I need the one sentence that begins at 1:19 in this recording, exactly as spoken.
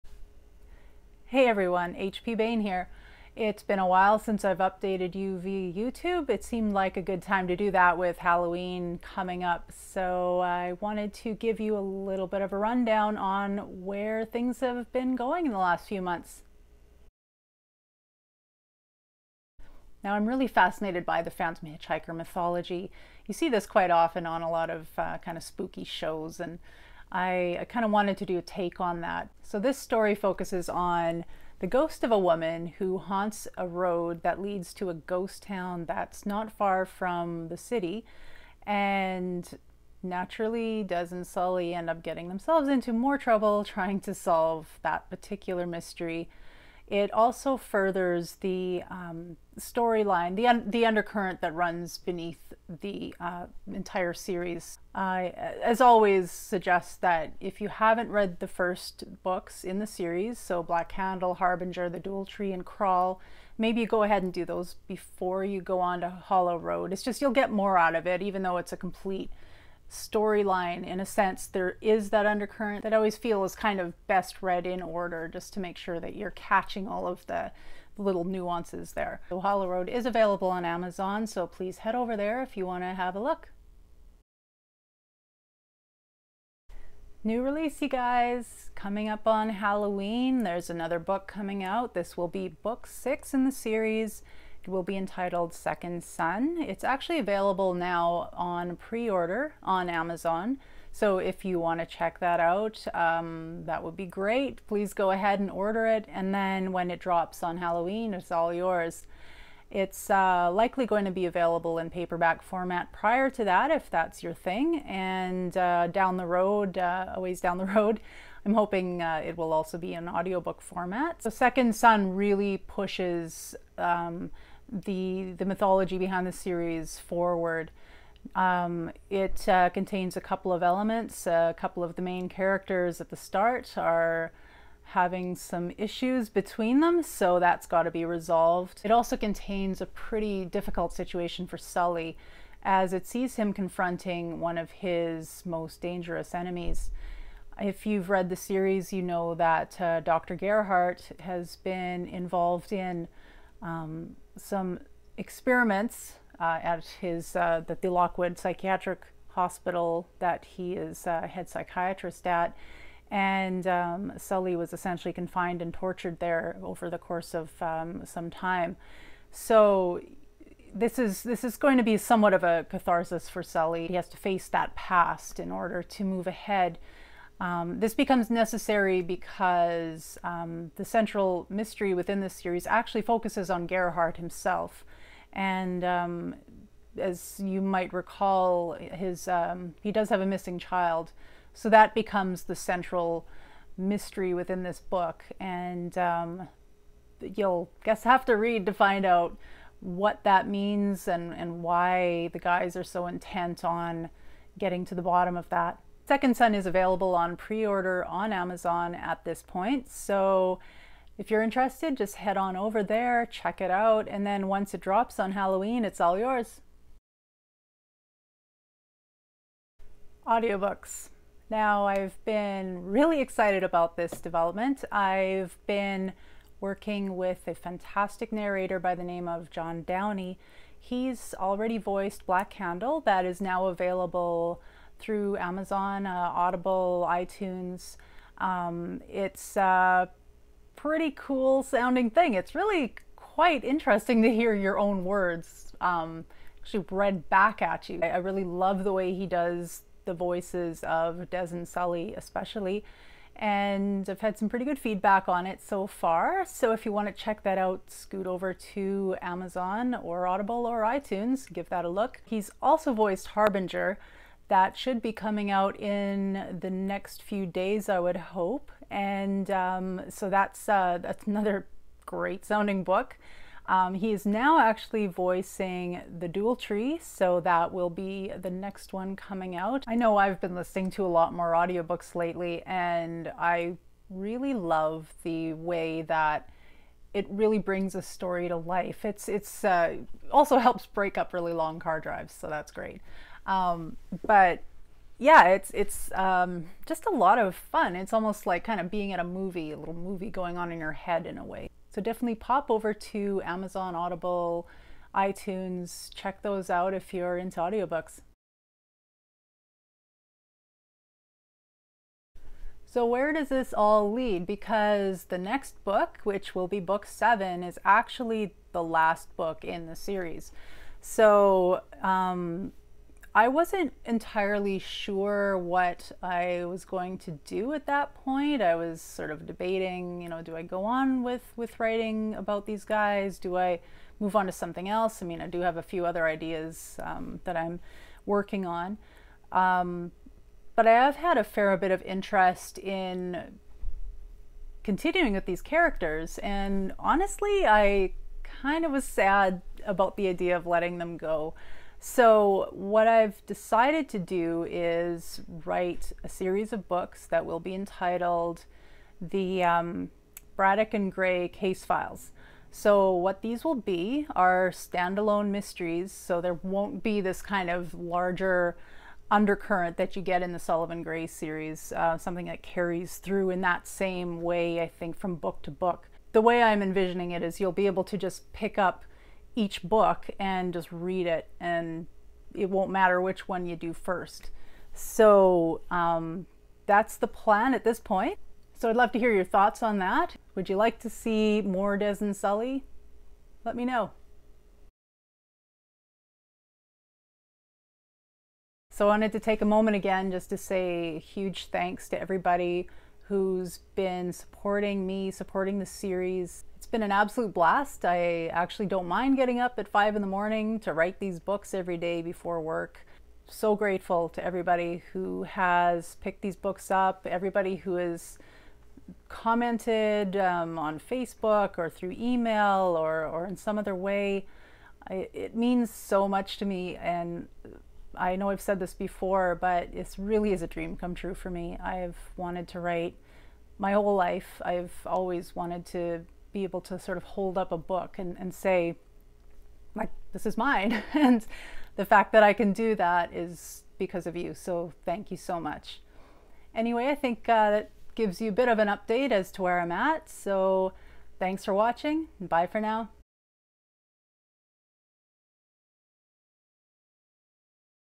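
So Hollow Road is available on Amazon so please head over there if you want to have a look.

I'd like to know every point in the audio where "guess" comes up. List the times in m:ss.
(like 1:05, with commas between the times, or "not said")
3:17.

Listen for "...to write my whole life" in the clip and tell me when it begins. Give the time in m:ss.
7:12.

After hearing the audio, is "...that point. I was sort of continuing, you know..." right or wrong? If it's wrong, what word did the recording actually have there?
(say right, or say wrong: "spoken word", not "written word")
wrong: "debating", not "continuing".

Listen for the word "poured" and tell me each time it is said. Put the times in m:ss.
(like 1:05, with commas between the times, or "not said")
not said.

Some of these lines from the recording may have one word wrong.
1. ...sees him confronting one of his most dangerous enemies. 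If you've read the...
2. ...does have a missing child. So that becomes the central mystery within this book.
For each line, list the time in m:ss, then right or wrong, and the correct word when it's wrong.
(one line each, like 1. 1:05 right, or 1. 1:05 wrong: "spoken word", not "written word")
1. 2:23 right
2. 3:09 right.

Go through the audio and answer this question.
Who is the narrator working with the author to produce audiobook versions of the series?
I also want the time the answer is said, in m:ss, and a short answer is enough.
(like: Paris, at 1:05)
John Downey, at 3:49.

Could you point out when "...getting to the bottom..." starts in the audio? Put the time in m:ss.
3:24.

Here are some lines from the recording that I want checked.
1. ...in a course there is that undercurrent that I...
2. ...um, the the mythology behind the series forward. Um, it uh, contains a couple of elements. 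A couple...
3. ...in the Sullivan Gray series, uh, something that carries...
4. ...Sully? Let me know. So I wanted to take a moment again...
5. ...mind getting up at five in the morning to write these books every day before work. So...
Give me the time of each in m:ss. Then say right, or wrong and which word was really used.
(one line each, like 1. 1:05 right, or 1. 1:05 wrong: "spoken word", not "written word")
1. 1:10 wrong: "sense", not "course"
2. 2:03 right
3. 6:10 right
4. 6:32 right
5. 6:49 right.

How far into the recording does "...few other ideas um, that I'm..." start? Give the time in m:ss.
5:35.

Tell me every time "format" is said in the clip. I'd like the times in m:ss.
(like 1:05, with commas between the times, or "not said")
1:52, 2:00.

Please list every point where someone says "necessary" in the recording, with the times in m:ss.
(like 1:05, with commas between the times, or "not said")
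2:58.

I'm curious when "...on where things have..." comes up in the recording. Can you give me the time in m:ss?
0:13.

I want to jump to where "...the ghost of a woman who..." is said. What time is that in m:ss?
0:31.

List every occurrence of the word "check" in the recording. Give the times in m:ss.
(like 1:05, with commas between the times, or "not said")
1:41, 3:33, 4:17, 5:06.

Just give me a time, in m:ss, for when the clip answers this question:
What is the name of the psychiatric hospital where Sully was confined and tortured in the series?
2:37.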